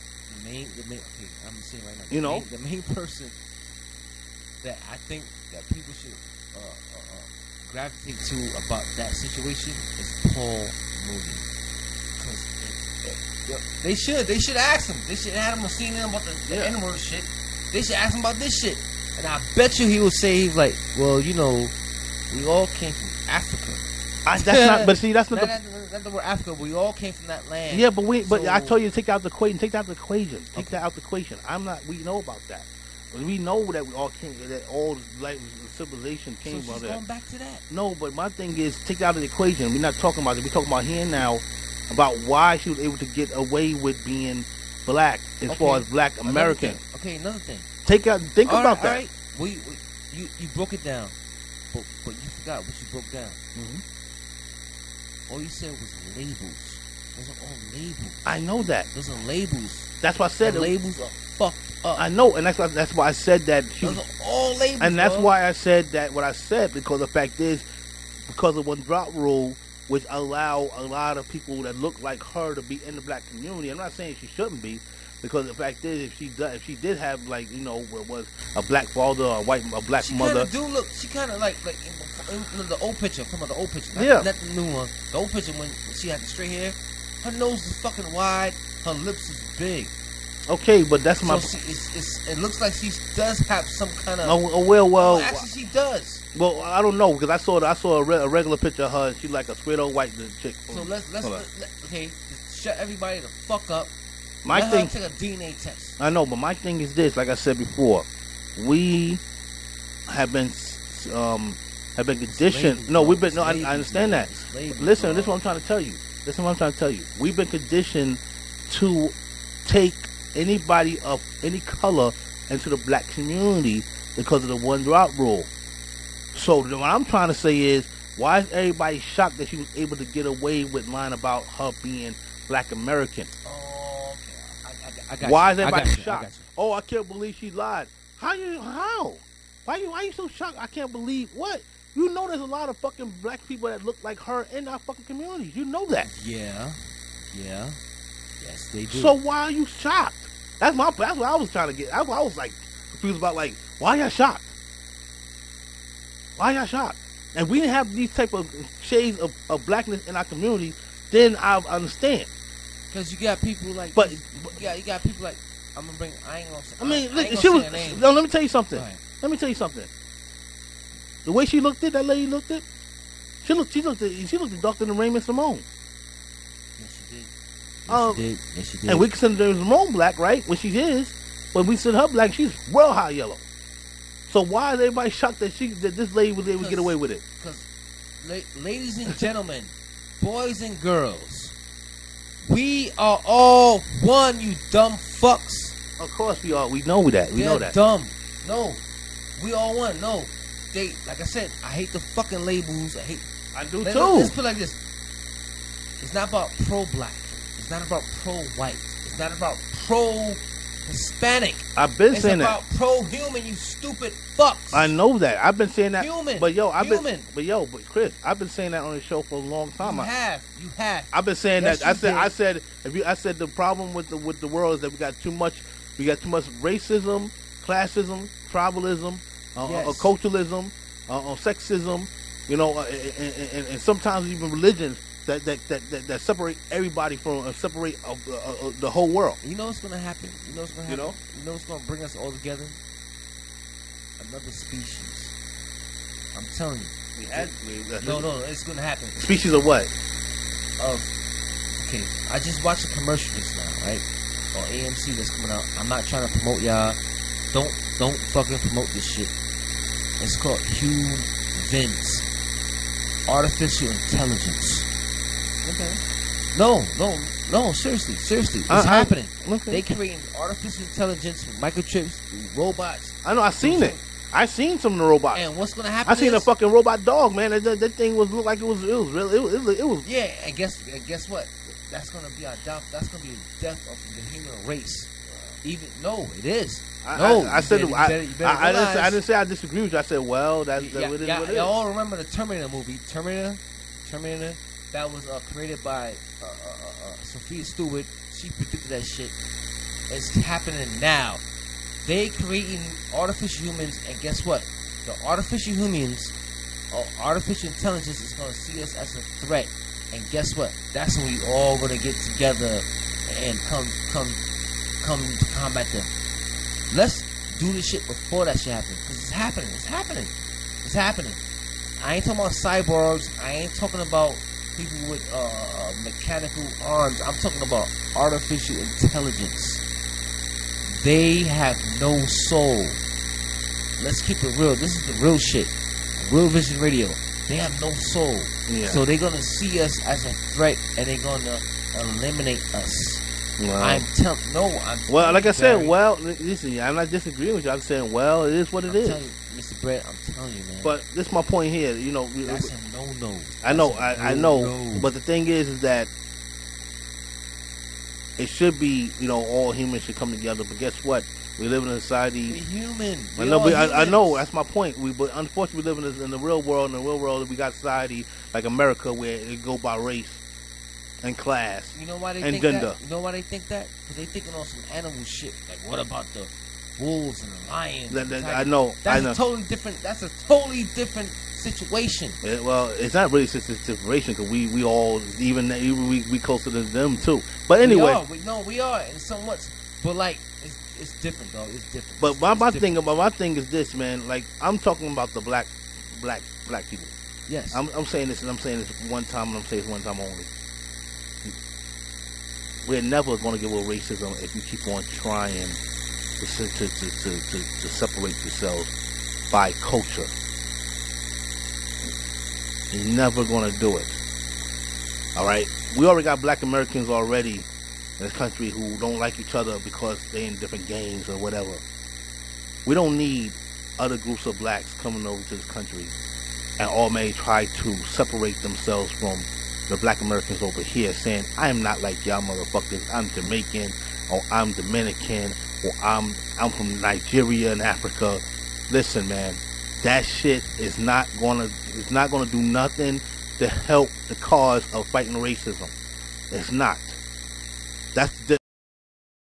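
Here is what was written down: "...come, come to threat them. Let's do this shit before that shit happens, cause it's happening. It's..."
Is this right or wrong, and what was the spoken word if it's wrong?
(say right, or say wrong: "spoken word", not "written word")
wrong: "combat", not "threat".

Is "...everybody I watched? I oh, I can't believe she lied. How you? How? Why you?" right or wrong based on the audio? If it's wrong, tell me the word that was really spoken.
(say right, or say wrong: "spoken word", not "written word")
wrong: "shocked", not "watched".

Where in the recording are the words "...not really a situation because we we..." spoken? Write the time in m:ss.
6:23.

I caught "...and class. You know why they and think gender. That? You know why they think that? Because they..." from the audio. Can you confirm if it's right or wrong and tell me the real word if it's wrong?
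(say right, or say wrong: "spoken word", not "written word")
right.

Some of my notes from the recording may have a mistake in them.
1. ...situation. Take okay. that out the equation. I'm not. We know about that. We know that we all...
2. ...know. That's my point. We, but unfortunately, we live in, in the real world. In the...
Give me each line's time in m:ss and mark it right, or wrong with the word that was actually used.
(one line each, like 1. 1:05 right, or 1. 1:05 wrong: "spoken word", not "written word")
1. 0:29 wrong: "equation", not "situation"
2. 6:04 right.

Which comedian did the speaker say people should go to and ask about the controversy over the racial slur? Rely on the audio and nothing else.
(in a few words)
Paul Mooney.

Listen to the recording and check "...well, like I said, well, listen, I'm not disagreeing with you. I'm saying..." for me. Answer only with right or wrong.
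right.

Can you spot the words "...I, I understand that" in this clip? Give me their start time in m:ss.
1:53.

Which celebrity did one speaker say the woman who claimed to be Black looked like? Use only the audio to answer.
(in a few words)
Raven-Symoné.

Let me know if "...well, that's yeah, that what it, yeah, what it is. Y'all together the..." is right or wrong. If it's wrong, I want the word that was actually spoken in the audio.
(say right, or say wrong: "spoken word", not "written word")
wrong: "remember", not "together".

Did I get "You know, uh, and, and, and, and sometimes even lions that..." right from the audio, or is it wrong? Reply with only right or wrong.
wrong.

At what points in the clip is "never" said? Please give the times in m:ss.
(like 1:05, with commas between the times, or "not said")
6:43, 6:53.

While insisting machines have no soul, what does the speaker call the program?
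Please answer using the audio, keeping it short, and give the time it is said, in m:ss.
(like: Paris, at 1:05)
Real Vision Radio, at 5:36.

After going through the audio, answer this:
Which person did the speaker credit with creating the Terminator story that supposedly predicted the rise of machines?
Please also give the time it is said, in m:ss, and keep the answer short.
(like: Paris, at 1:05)
Sophia Stewart, at 4:57.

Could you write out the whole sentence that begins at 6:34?
Like I'm talking about the black black black people.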